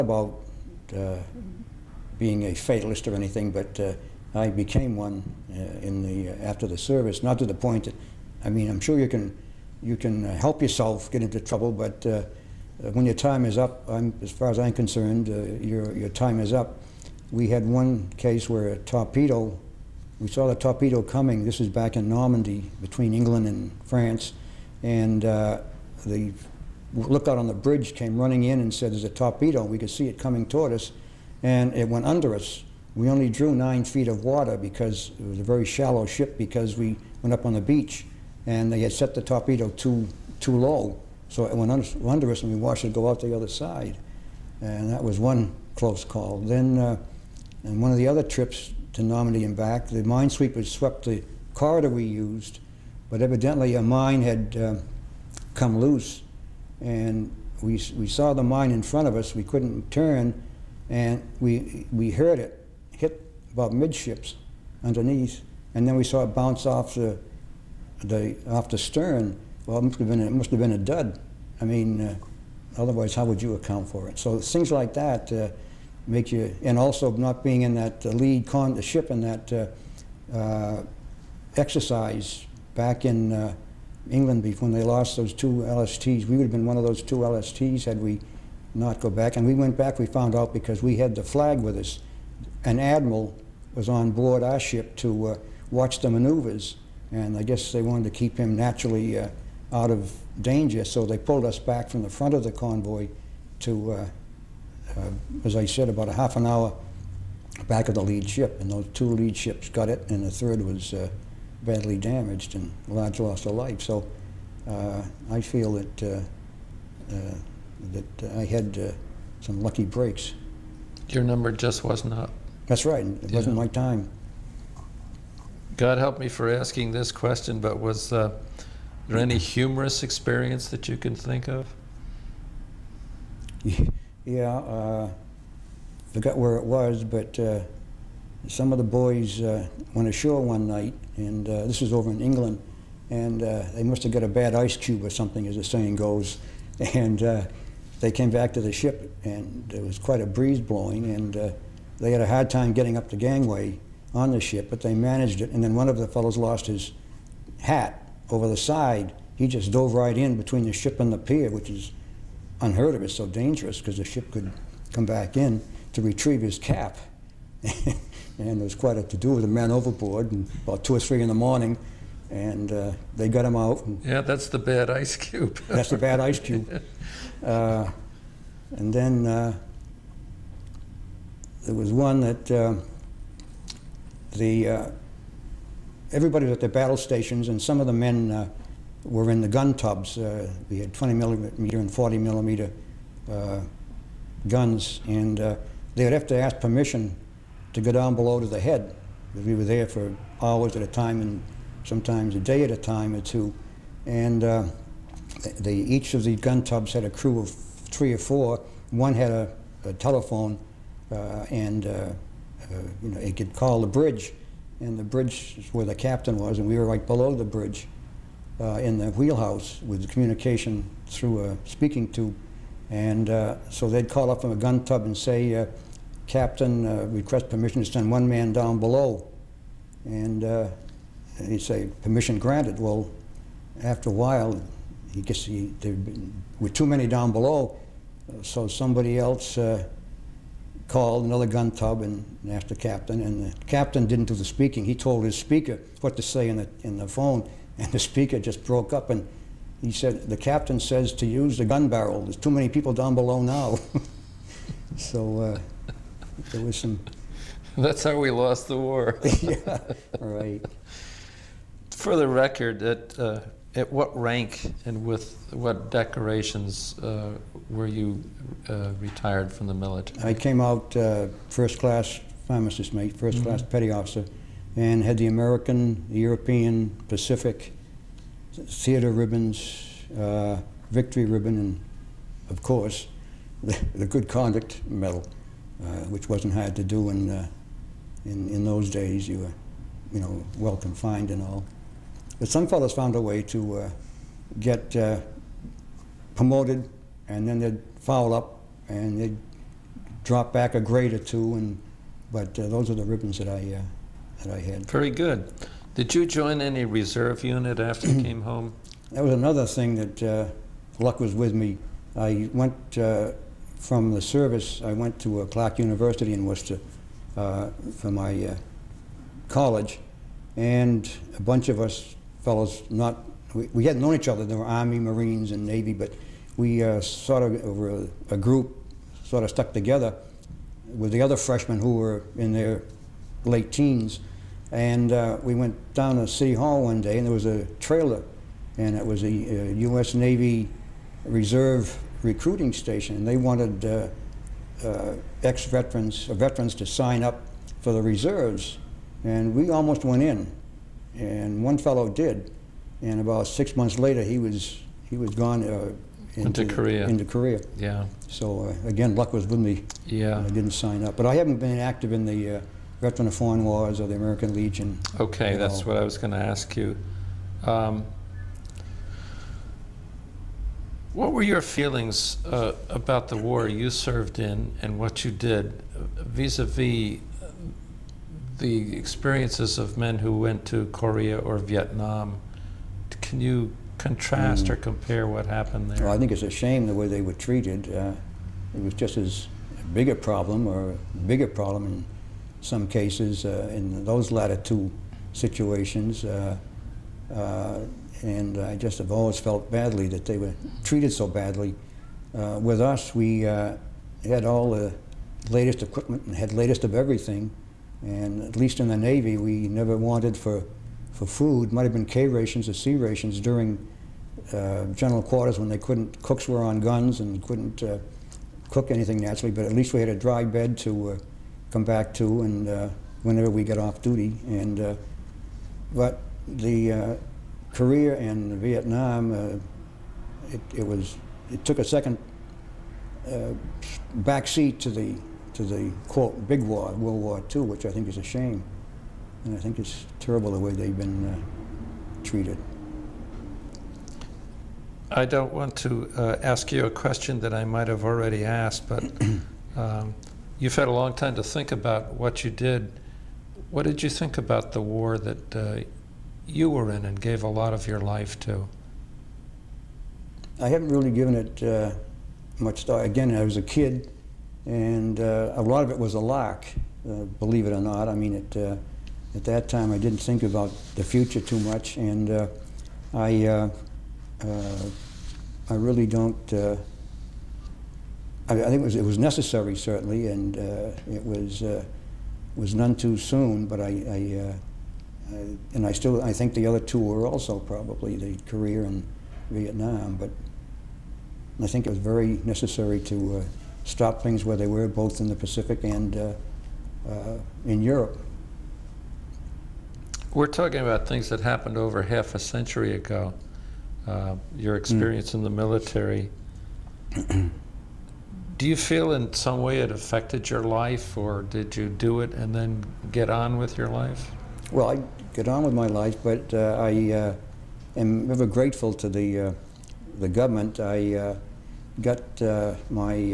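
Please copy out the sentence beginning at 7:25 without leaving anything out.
I don't want to ask you a question that I might have already asked, but.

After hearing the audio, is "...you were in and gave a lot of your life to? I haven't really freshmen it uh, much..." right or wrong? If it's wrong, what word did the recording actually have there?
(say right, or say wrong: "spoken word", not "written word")
wrong: "given", not "freshmen".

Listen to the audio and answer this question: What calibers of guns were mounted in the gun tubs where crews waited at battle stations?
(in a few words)
20 and 40 millimeter.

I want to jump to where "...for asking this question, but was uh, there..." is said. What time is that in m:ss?
2:06.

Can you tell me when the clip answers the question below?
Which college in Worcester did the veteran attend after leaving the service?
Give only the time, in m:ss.
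5:15.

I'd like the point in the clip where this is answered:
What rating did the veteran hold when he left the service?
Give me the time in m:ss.
4:31.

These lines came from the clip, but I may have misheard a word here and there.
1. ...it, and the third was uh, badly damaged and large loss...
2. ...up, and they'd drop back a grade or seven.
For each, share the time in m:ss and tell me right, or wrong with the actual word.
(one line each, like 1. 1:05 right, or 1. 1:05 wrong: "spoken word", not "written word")
1. 1:49 right
2. 4:58 wrong: "two", not "seven".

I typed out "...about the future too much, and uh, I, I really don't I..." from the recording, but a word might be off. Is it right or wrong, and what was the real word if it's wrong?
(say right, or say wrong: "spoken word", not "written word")
right.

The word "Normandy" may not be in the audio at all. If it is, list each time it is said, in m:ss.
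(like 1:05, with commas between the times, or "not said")
0:22, 0:49.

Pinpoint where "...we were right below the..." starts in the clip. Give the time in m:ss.
3:36.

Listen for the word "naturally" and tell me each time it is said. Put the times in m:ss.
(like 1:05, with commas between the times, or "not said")
1:38, 6:59.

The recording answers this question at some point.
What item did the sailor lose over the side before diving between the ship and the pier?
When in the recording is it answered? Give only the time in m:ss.
2:37.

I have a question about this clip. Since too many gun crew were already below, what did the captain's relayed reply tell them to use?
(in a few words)
The gun barrel.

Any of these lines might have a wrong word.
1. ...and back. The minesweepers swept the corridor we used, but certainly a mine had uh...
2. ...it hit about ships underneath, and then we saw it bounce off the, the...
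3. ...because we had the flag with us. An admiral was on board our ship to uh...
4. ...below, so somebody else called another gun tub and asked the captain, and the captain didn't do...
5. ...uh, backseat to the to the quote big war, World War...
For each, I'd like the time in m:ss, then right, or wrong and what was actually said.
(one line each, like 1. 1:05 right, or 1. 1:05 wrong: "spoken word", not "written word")
1. 0:49 wrong: "evidently", not "certainly"
2. 1:02 wrong: "midships", not "ships"
3. 1:30 right
4. 3:57 right
5. 7:13 right.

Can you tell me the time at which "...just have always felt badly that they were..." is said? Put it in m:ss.
6:38.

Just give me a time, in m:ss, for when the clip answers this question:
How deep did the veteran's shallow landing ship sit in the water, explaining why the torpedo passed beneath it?
0:33.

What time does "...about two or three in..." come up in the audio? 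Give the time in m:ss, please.
2:50.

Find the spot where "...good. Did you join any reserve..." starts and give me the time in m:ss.
5:05.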